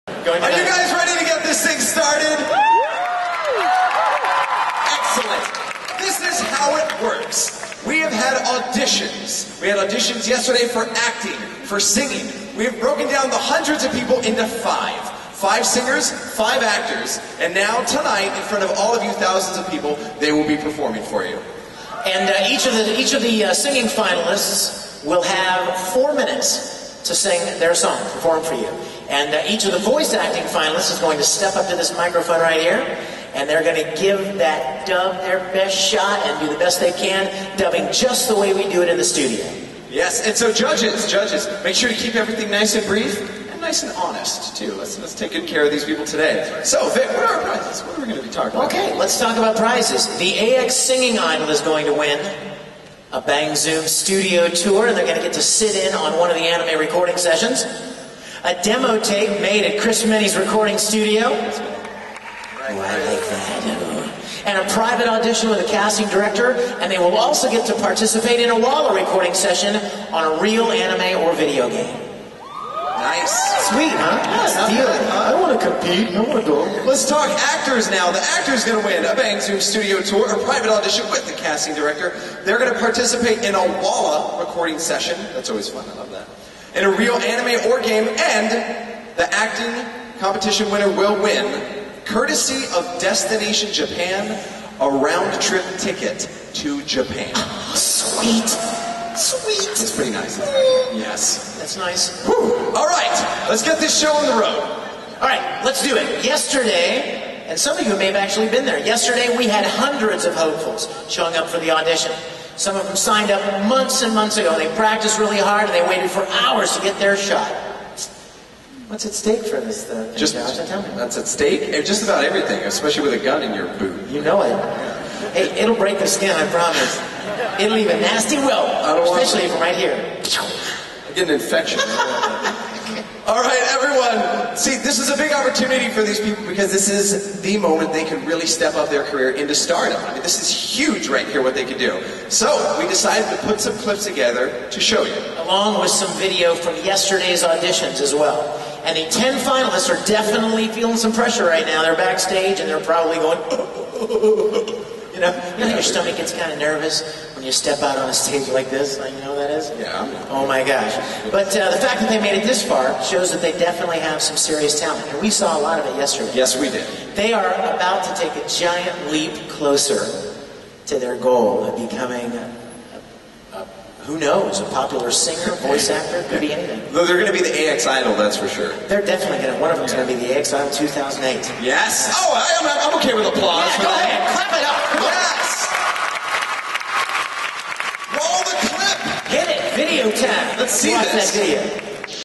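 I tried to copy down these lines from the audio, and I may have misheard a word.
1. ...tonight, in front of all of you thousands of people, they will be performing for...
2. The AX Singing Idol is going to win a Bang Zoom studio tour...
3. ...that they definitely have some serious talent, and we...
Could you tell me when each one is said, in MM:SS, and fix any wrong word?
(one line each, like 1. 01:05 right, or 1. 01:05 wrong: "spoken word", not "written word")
1. 00:17 right
2. 00:50 right
3. 02:43 right.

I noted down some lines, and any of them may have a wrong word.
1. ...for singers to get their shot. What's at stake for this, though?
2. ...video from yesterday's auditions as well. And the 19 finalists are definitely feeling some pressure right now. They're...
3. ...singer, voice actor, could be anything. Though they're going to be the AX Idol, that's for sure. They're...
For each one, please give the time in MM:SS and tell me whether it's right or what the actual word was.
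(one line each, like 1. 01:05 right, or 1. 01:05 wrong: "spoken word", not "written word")
1. 01:56 wrong: "hours", not "singers"
2. 02:26 wrong: "10", not "19"
3. 02:55 right.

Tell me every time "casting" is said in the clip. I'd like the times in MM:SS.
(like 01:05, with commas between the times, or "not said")
01:05, 01:21.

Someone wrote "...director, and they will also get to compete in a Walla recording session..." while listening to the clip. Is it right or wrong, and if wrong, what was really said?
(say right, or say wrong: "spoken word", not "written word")
wrong: "participate", not "compete".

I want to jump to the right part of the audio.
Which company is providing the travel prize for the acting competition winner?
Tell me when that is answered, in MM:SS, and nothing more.
01:32.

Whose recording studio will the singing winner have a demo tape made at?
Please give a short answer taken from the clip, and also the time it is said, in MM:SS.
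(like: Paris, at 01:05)
Chris Minnie's, at 00:59.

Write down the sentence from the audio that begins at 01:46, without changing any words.
Yesterday, and some of you may have actually been there.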